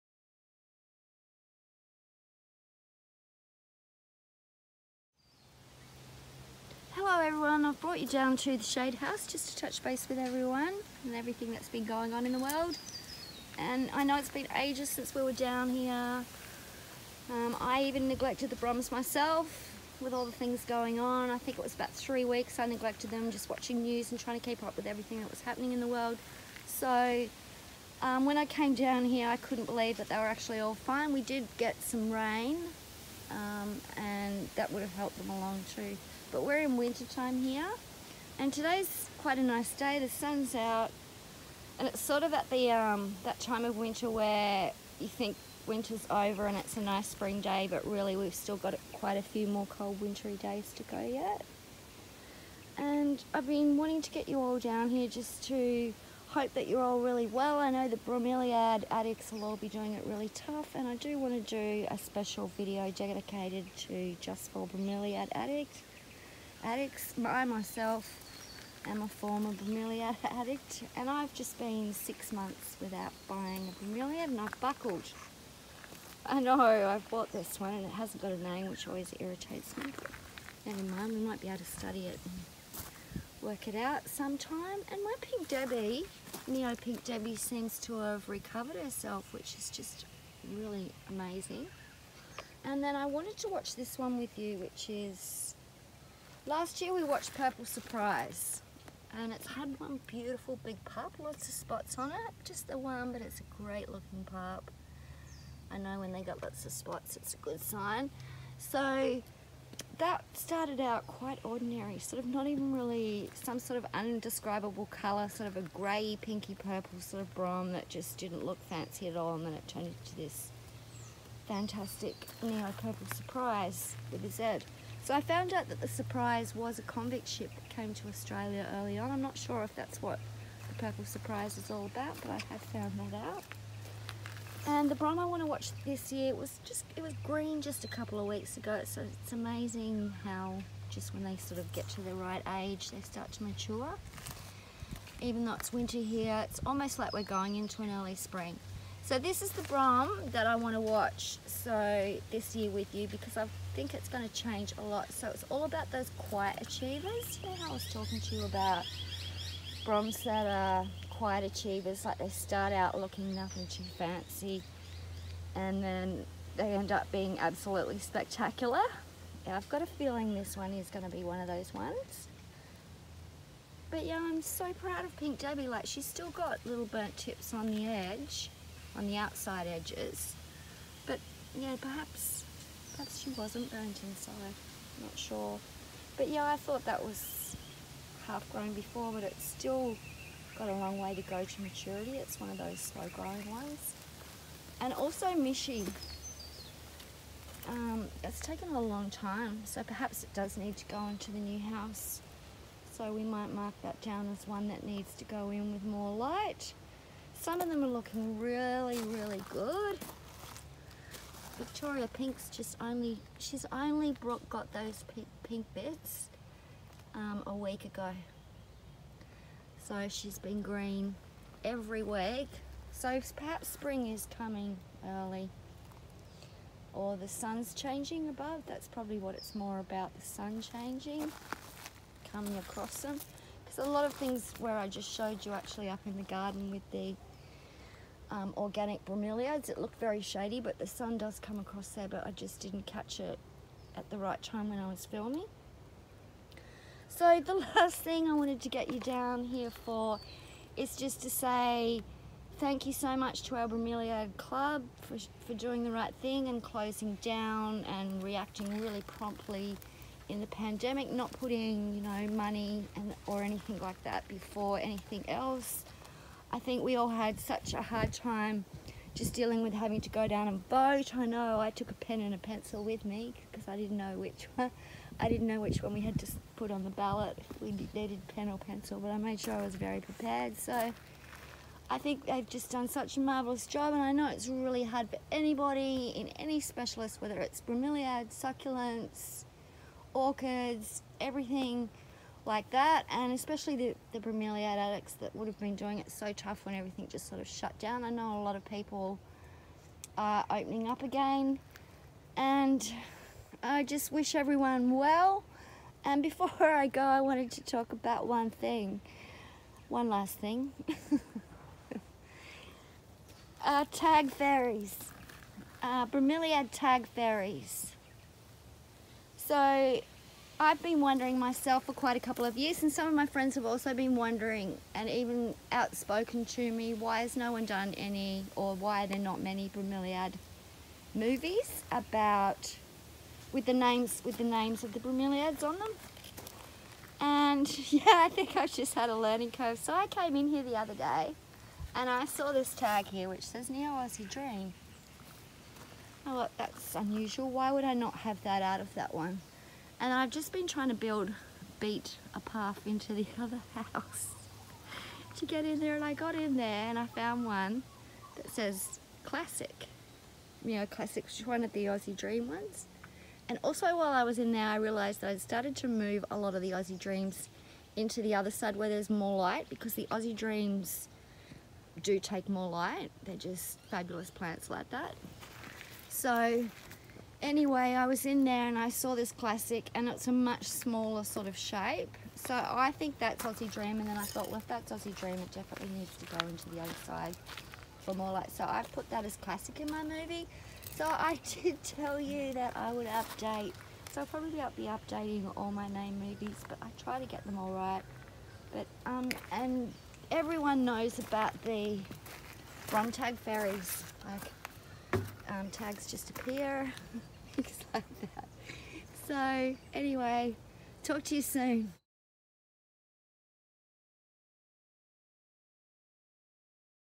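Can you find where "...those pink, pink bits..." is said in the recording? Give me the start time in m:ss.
3:34.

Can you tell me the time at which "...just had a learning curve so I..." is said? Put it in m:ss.
5:38.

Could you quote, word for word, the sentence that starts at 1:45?
I know when they got lots of spots it's a good sign.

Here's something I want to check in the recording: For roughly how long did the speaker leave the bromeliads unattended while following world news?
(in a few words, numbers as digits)
3 weeks.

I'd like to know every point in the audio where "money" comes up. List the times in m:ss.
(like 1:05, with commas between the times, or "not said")
4:22.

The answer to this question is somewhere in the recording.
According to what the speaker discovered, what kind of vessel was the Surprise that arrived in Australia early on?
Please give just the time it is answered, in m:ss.
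2:06.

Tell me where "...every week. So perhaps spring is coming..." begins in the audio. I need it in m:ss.
3:41.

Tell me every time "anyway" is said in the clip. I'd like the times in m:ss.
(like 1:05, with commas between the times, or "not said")
6:17, 6:49.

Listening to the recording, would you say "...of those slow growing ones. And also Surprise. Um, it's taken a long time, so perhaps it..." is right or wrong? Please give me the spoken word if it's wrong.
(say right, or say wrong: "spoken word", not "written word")
wrong: "Mishi", not "Surprise".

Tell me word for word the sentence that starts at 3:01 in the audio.
But yeah, perhaps Perhaps she wasn't burnt inside, I'm not sure.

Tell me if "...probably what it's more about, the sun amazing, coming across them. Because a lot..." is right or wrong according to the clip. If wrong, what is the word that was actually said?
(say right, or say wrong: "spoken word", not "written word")
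wrong: "changing", not "amazing".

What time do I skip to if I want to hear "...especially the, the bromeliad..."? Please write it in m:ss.
4:53.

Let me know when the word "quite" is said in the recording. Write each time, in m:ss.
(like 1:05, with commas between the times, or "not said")
0:39, 0:48, 1:51, 5:21.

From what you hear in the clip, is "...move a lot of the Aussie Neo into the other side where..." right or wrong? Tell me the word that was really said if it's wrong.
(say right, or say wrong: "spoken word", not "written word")
wrong: "Dreams", not "Neo".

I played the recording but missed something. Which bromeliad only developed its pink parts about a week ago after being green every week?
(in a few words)
Victoria Pink.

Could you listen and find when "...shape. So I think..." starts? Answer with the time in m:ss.
6:21.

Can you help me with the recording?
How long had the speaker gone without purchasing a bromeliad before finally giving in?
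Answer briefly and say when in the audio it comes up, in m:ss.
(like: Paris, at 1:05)
6 months, at 1:11.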